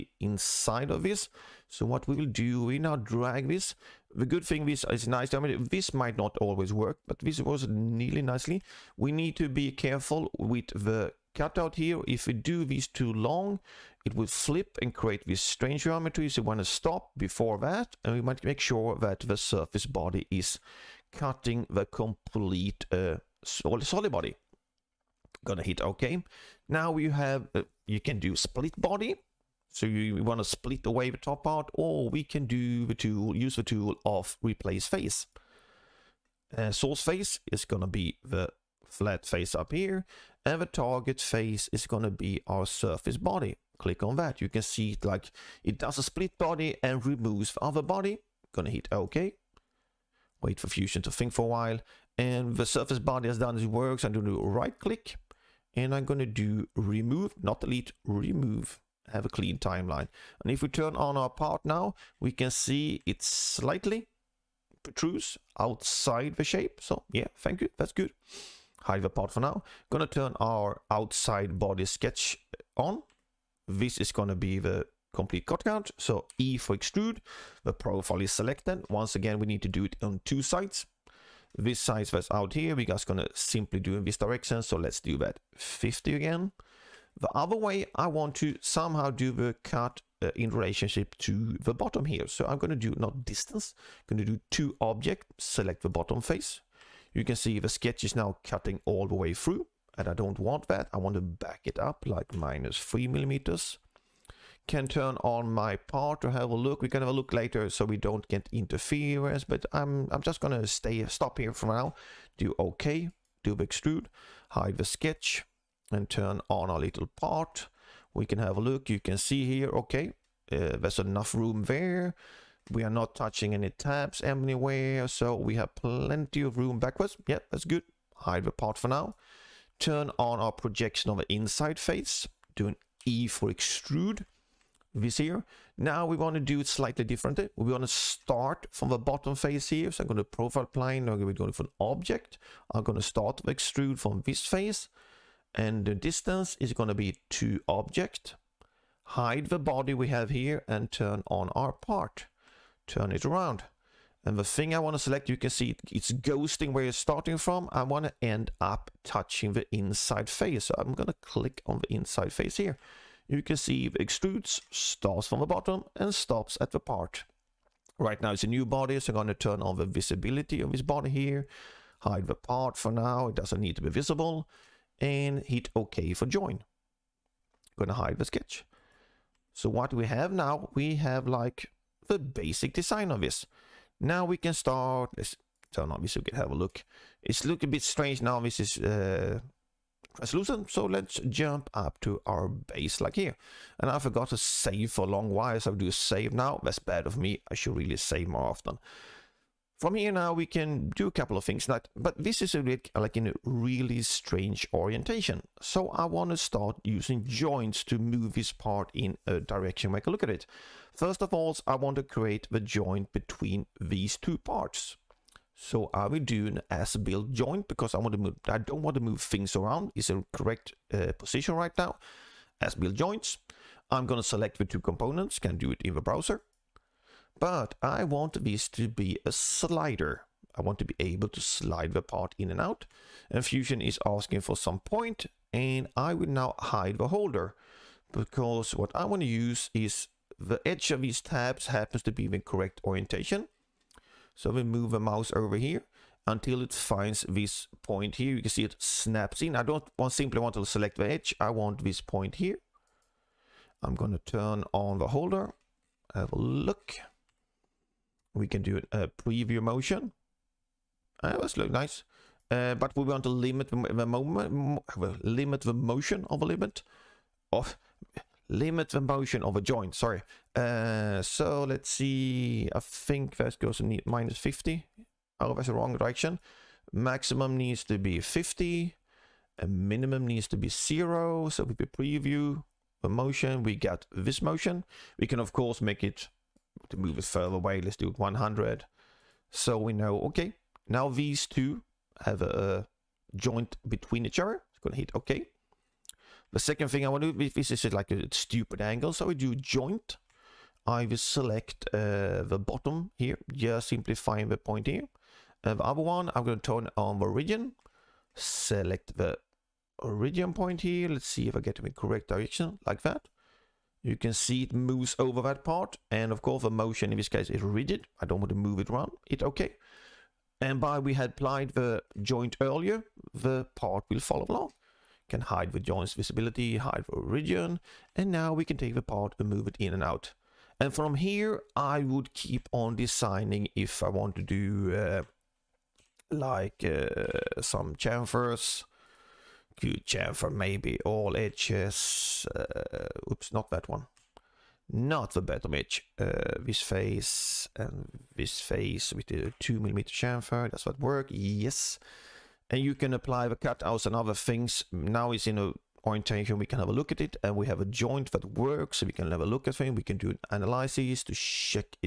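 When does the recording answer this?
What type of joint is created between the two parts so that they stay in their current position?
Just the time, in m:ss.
3:36.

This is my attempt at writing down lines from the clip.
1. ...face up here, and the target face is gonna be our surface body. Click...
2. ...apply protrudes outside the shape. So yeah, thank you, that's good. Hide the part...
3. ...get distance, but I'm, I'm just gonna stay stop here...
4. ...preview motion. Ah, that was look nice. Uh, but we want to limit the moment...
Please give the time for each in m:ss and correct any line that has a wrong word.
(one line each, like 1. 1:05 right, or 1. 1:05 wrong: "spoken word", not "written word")
1. 0:39 right
2. 1:03 wrong: "slightly", not "apply"
3. 1:48 wrong: "interference", not "distance"
4. 4:19 right.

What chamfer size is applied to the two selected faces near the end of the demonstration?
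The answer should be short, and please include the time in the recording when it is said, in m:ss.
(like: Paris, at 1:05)
2 mm, at 5:49.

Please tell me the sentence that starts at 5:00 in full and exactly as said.
I will select uh, the bottom here, just simplifying the point here.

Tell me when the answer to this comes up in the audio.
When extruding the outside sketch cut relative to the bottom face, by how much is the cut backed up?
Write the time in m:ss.
1:42.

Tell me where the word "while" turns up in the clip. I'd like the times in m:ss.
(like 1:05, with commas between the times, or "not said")
0:51, 3:15.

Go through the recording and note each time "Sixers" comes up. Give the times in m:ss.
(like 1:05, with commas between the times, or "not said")
not said.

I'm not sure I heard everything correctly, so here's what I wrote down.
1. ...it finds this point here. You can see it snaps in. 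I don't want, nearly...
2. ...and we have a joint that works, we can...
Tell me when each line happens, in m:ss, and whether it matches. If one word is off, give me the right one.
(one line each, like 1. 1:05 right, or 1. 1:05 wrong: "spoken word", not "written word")
1. 4:06 wrong: "simply", not "nearly"
2. 5:57 right.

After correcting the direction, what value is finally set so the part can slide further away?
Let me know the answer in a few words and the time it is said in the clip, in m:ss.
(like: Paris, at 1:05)
100, at 4:48.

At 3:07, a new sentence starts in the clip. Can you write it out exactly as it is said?
It's looking a bit strange now, this is uh, resolution.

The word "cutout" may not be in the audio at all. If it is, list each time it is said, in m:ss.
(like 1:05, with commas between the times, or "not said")
0:11, 5:53.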